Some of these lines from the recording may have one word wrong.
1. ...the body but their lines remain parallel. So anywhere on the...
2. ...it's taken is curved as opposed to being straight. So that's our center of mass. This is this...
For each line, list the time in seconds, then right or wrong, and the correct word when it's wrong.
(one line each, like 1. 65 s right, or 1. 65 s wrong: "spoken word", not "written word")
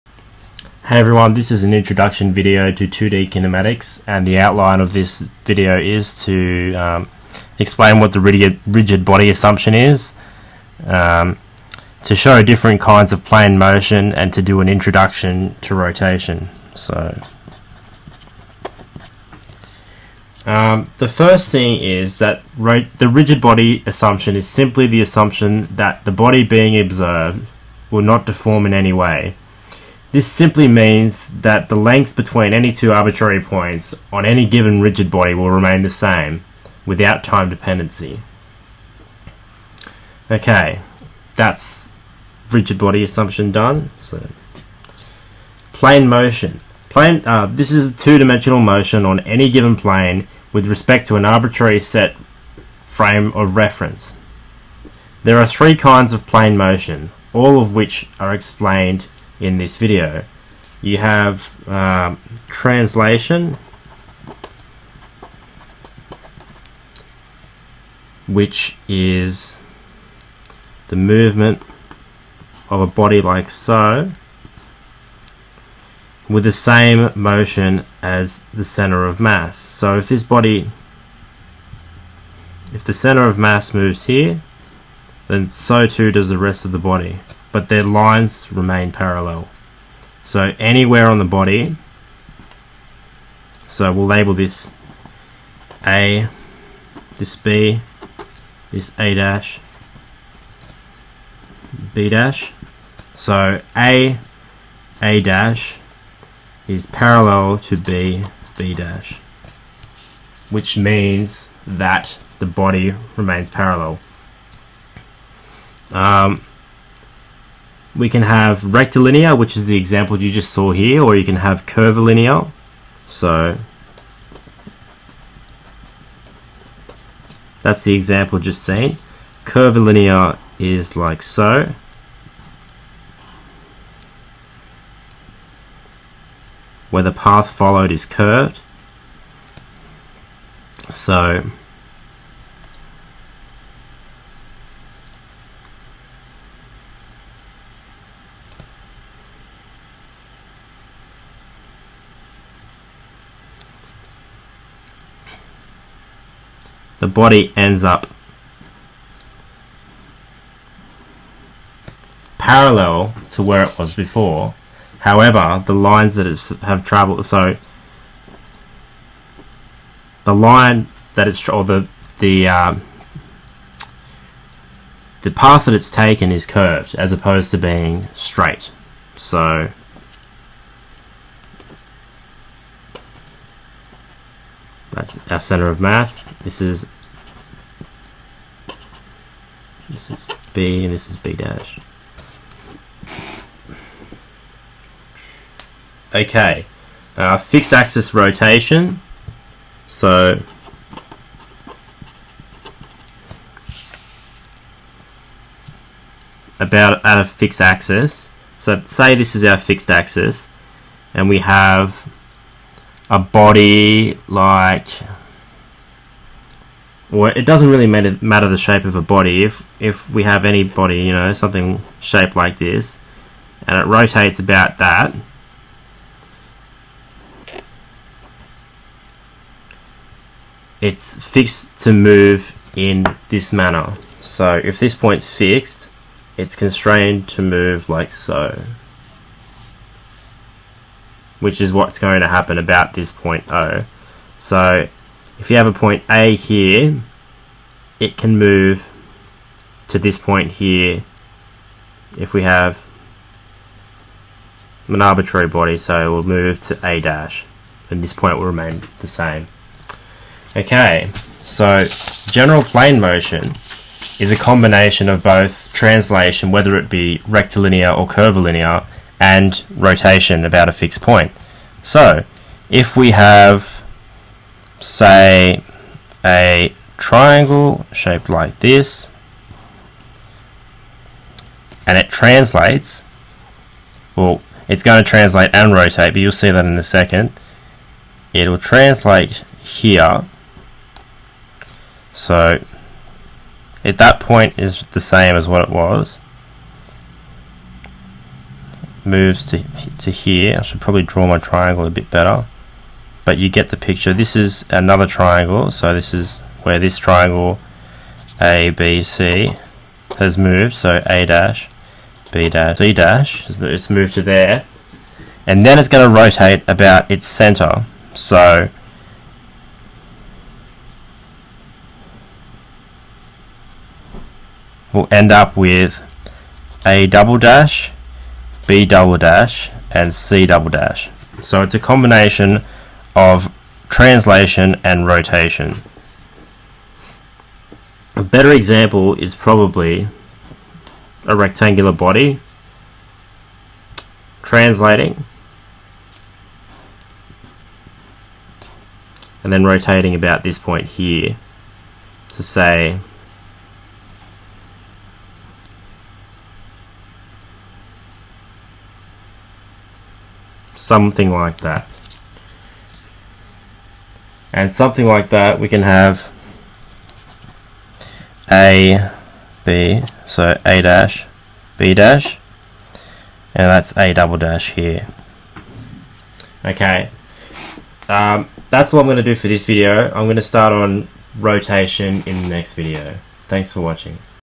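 1. 86 s right
2. 175 s right.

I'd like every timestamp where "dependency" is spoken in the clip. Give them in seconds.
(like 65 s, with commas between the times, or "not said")
37 s.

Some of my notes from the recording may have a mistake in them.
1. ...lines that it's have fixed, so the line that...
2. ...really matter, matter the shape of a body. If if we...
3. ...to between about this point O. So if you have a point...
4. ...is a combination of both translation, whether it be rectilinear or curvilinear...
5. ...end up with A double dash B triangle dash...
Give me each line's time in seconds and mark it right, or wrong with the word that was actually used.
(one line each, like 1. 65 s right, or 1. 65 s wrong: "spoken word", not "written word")
1. 165 s wrong: "traveled", not "fixed"
2. 217 s right
3. 242 s wrong: "happen", not "between"
4. 264 s right
5. 325 s wrong: "double", not "triangle".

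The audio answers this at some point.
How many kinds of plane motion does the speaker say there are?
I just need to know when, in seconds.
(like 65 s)
55 s.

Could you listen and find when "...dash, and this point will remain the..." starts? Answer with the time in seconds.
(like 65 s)
257 s.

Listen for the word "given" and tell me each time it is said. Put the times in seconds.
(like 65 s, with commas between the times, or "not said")
34 s, 49 s.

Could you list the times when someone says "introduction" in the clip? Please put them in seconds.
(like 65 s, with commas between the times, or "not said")
1 s, 14 s.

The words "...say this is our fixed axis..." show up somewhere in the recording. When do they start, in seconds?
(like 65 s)
208 s.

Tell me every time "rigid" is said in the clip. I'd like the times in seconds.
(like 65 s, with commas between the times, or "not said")
8 s, 23 s, 34 s, 42 s.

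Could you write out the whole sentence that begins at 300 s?
I should probably draw my triangle a bit better.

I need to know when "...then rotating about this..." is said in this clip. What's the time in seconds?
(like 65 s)
349 s.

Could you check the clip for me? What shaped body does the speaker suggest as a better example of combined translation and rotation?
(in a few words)
Rectangular body.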